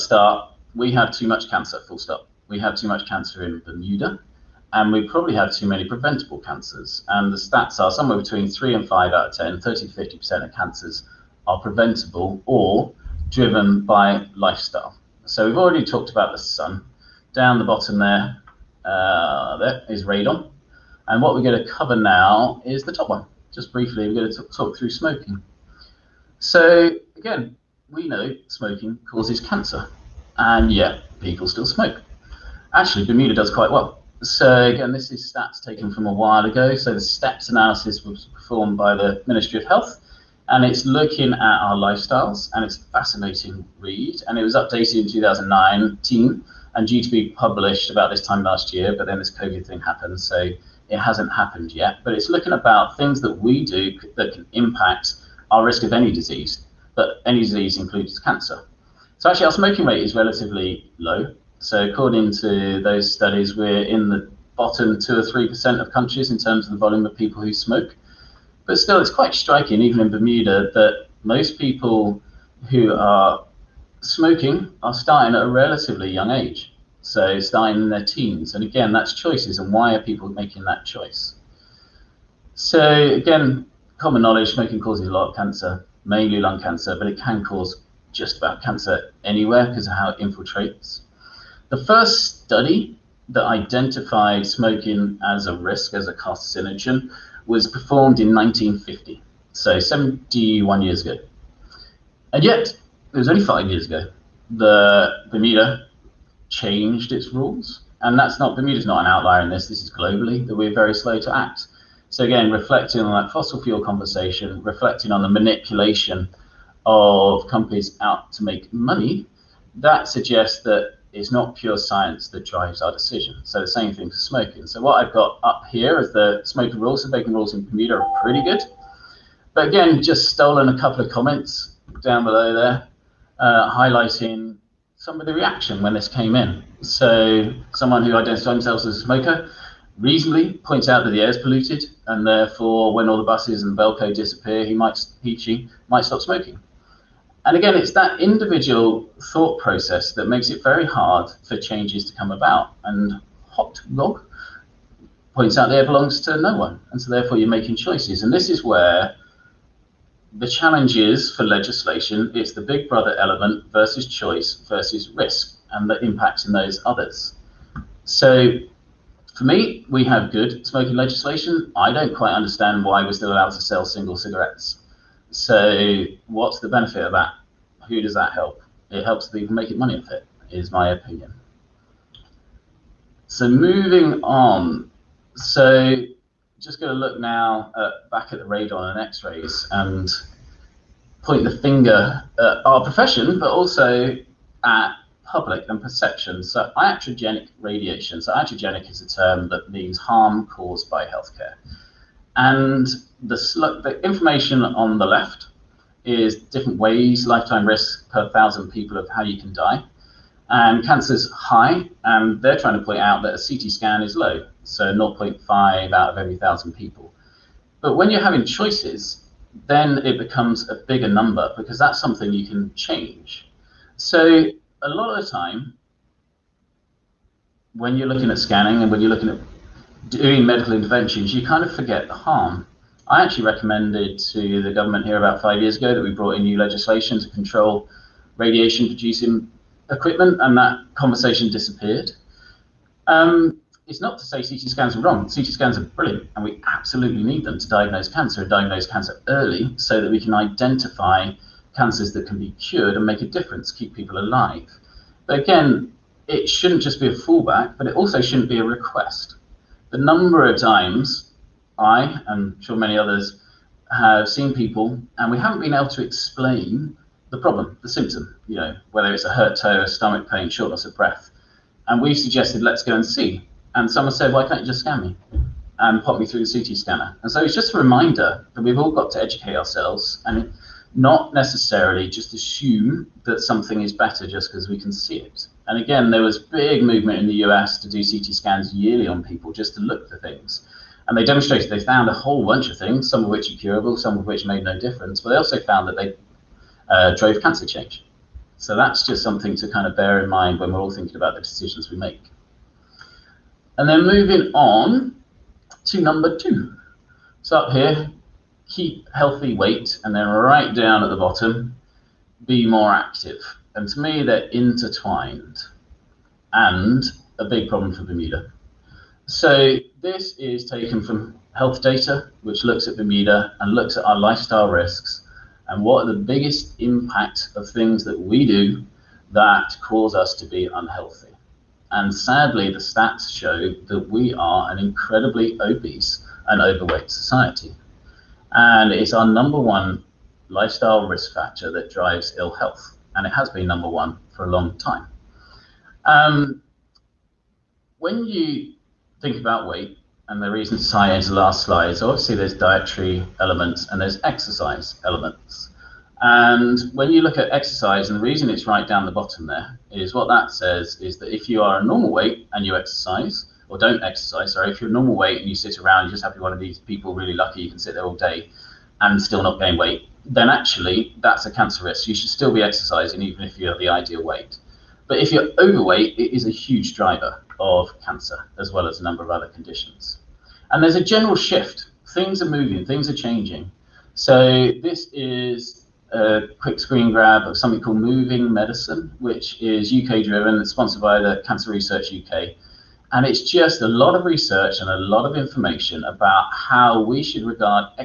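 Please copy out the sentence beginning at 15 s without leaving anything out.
So, we've already talked about the sun.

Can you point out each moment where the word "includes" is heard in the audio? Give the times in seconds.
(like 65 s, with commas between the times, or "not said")
57 s.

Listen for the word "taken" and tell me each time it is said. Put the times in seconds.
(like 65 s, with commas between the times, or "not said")
35 s, 320 s.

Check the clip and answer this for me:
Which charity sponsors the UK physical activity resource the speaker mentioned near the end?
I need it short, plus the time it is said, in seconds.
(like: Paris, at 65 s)
Cancer Research UK, at 391 s.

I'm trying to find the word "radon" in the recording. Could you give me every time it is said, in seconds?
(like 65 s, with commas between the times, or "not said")
20 s, 188 s.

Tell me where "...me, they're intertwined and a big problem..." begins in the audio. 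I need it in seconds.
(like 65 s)
313 s.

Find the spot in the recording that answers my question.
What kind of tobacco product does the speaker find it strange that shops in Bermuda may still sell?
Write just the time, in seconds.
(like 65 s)
173 s.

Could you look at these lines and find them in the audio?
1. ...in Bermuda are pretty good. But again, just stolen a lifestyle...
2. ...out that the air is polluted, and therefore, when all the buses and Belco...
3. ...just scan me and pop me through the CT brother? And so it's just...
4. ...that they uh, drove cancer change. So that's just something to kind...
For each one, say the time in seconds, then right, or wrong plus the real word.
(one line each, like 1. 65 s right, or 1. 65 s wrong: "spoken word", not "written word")
1. 127 s wrong: "couple", not "lifestyle"
2. 140 s right
3. 274 s wrong: "scanner", not "brother"
4. 295 s right.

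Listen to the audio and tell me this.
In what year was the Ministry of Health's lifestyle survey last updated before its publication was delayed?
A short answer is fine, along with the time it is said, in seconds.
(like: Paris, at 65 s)
2019, at 45 s.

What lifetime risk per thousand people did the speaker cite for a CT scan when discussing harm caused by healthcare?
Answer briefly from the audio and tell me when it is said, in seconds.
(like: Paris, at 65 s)
0.5, at 214 s.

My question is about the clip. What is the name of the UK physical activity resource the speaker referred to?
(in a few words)
Moving Medicine.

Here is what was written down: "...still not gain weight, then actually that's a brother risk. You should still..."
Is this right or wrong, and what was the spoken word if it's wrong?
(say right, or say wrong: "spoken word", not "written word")
wrong: "cancer", not "brother".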